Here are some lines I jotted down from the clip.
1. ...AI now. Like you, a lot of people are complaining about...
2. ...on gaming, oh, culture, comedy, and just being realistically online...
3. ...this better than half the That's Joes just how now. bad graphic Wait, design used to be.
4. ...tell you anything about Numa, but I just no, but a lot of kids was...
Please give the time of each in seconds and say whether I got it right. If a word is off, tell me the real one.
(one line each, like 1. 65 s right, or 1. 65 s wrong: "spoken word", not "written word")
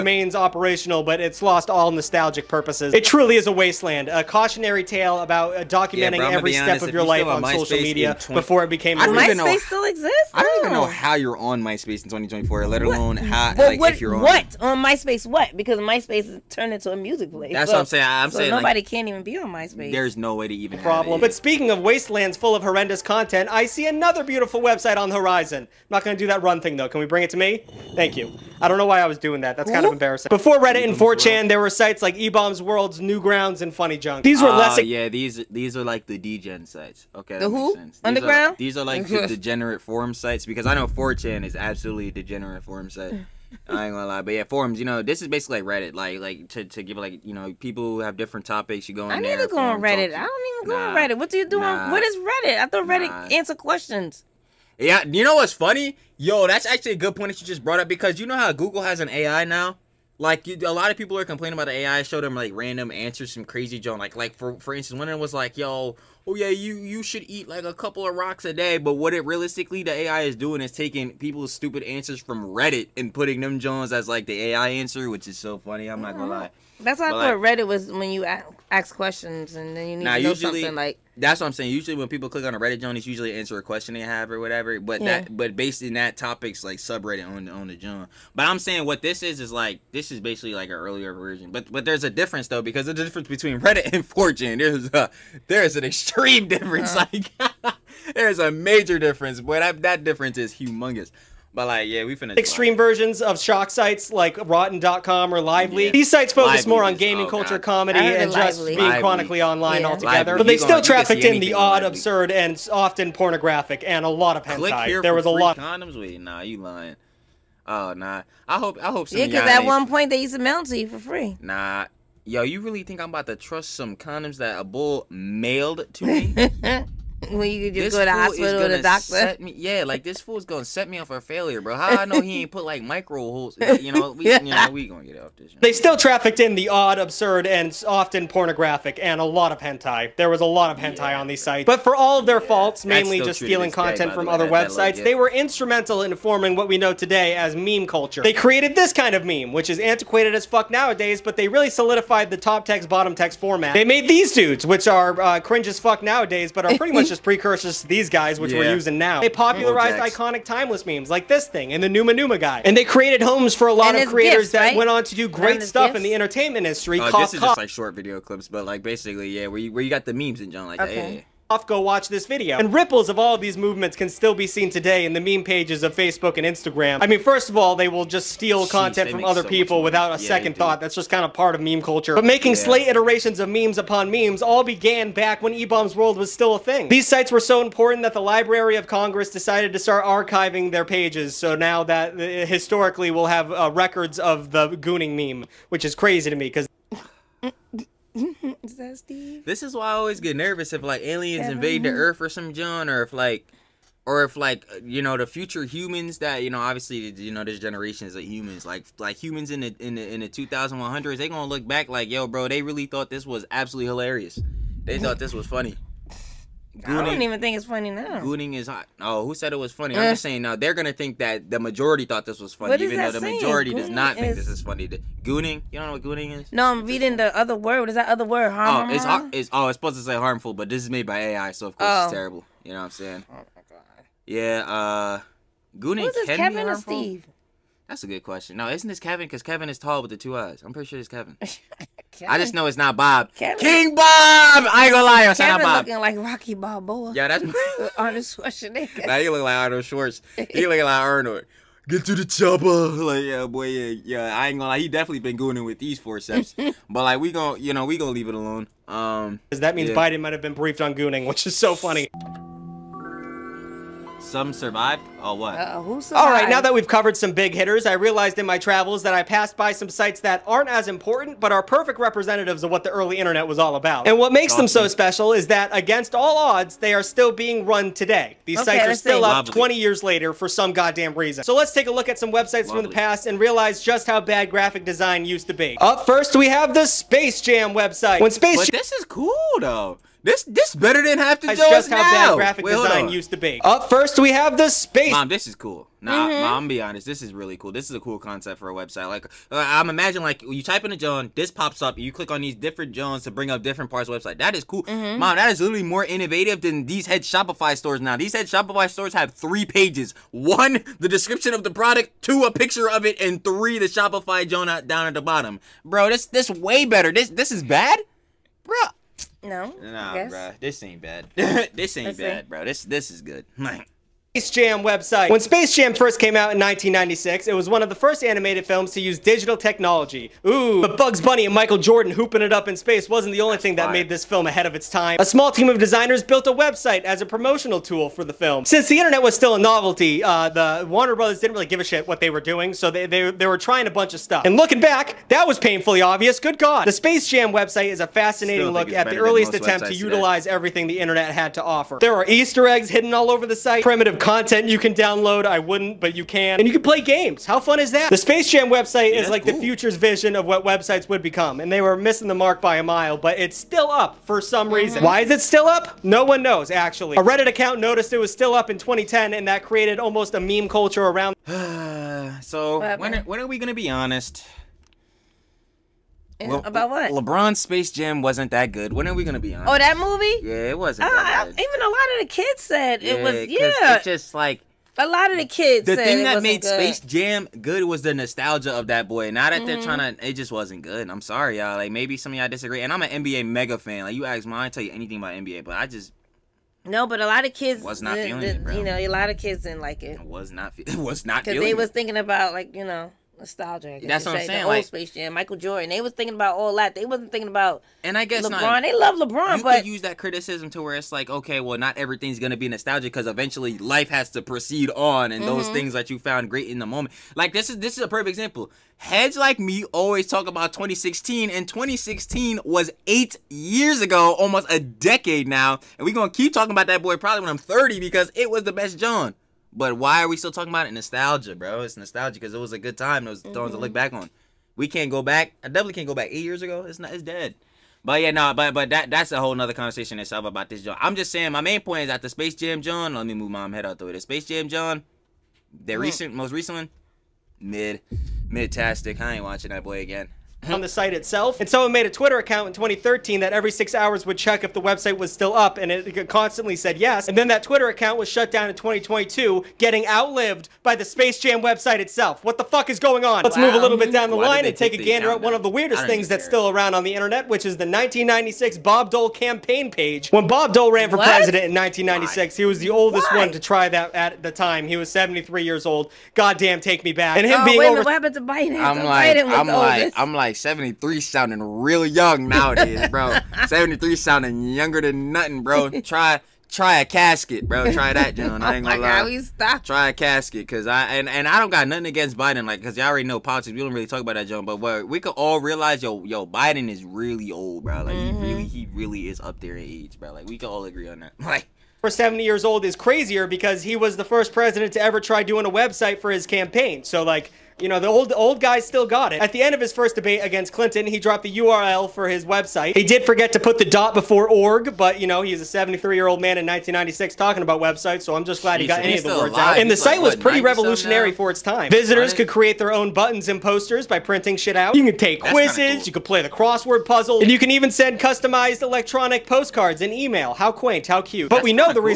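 1. 59 s right
2. 106 s wrong: "chronically", not "realistically"
3. 290 s right
4. 394 s wrong: "NBA", not "Numa".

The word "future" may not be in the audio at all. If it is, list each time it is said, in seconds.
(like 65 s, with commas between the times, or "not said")
205 s, 359 s.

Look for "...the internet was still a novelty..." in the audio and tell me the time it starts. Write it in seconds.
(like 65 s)
338 s.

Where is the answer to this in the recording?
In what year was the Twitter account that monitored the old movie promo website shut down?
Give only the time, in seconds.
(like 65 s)
458 s.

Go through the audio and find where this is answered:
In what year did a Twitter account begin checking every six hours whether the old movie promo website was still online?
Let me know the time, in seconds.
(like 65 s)
452 s.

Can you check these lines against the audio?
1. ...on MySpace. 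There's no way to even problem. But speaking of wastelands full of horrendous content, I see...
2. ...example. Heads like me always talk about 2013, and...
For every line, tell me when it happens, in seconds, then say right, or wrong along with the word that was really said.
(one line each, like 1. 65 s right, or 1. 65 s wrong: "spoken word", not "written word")
1. 19 s right
2. 418 s wrong: "2016", not "2013".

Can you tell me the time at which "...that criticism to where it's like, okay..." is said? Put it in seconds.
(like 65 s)
410 s.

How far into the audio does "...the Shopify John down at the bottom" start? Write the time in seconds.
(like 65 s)
313 s.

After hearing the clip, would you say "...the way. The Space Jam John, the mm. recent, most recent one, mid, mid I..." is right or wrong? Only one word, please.
right.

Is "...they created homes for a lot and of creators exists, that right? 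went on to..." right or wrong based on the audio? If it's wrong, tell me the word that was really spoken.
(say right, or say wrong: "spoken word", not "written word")
wrong: "gifts", not "exists".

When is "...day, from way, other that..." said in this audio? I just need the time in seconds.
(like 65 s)
144 s.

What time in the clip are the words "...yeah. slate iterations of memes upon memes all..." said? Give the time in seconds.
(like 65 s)
182 s.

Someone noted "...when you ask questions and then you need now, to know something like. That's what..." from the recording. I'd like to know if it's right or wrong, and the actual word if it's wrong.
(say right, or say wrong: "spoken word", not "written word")
right.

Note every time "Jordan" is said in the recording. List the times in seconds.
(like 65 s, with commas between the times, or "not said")
331 s, 405 s.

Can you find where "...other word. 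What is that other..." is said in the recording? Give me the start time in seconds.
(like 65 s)
227 s.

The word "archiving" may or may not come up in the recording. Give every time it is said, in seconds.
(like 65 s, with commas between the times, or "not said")
190 s.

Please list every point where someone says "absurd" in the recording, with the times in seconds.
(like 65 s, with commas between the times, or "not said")
111 s, 136 s.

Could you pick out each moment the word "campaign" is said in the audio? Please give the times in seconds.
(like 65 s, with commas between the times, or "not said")
469 s, 506 s.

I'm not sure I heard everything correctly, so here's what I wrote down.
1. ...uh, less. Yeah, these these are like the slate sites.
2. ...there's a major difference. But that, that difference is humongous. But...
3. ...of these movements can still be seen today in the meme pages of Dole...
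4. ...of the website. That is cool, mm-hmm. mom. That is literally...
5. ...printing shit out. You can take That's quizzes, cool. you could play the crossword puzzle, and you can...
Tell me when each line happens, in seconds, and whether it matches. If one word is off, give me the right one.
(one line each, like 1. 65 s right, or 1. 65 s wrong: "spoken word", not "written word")
1. 34 s wrong: "degenerate", not "slate"
2. 98 s right
3. 173 s wrong: "Facebook", not "Dole"
4. 304 s right
5. 524 s right.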